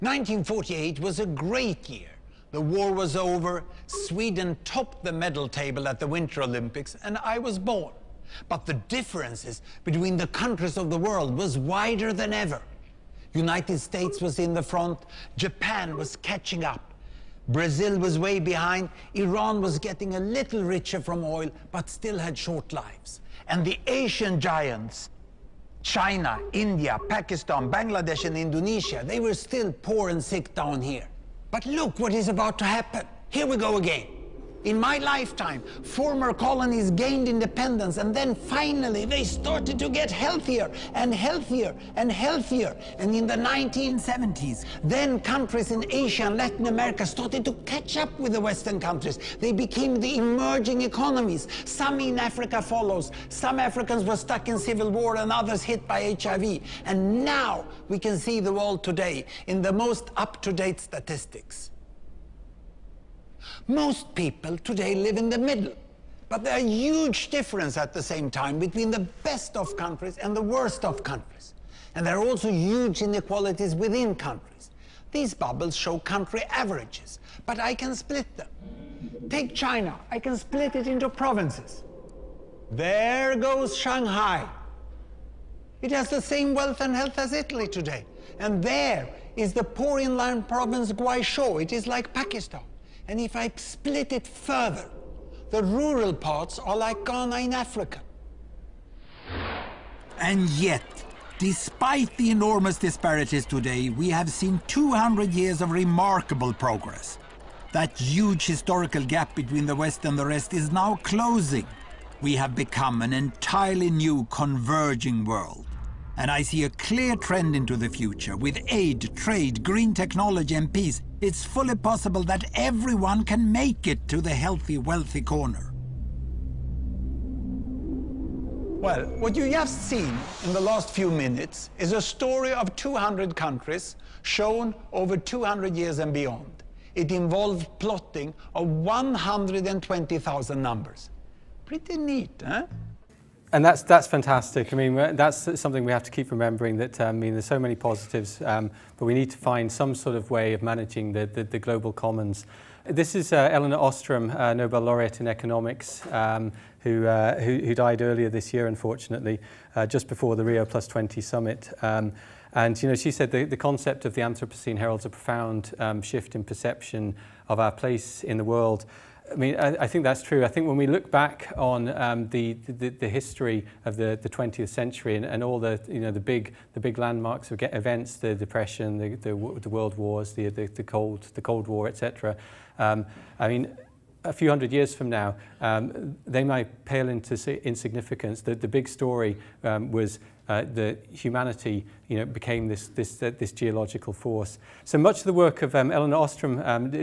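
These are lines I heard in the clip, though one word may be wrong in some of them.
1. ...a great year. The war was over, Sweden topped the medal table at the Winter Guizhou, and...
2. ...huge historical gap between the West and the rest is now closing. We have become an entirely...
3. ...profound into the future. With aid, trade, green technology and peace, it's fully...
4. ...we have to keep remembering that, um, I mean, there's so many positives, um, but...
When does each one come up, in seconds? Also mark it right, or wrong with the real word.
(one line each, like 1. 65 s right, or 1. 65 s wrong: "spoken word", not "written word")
1. 1 s wrong: "Olympics", not "Guizhou"
2. 107 s right
3. 117 s wrong: "trend", not "profound"
4. 145 s right.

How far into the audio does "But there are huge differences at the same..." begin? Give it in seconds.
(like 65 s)
66 s.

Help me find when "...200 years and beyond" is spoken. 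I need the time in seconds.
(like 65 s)
135 s.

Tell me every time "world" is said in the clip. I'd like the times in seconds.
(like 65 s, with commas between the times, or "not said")
10 s, 58 s, 115 s, 168 s, 179 s.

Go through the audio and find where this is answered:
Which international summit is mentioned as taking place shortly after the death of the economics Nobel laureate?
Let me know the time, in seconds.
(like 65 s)
160 s.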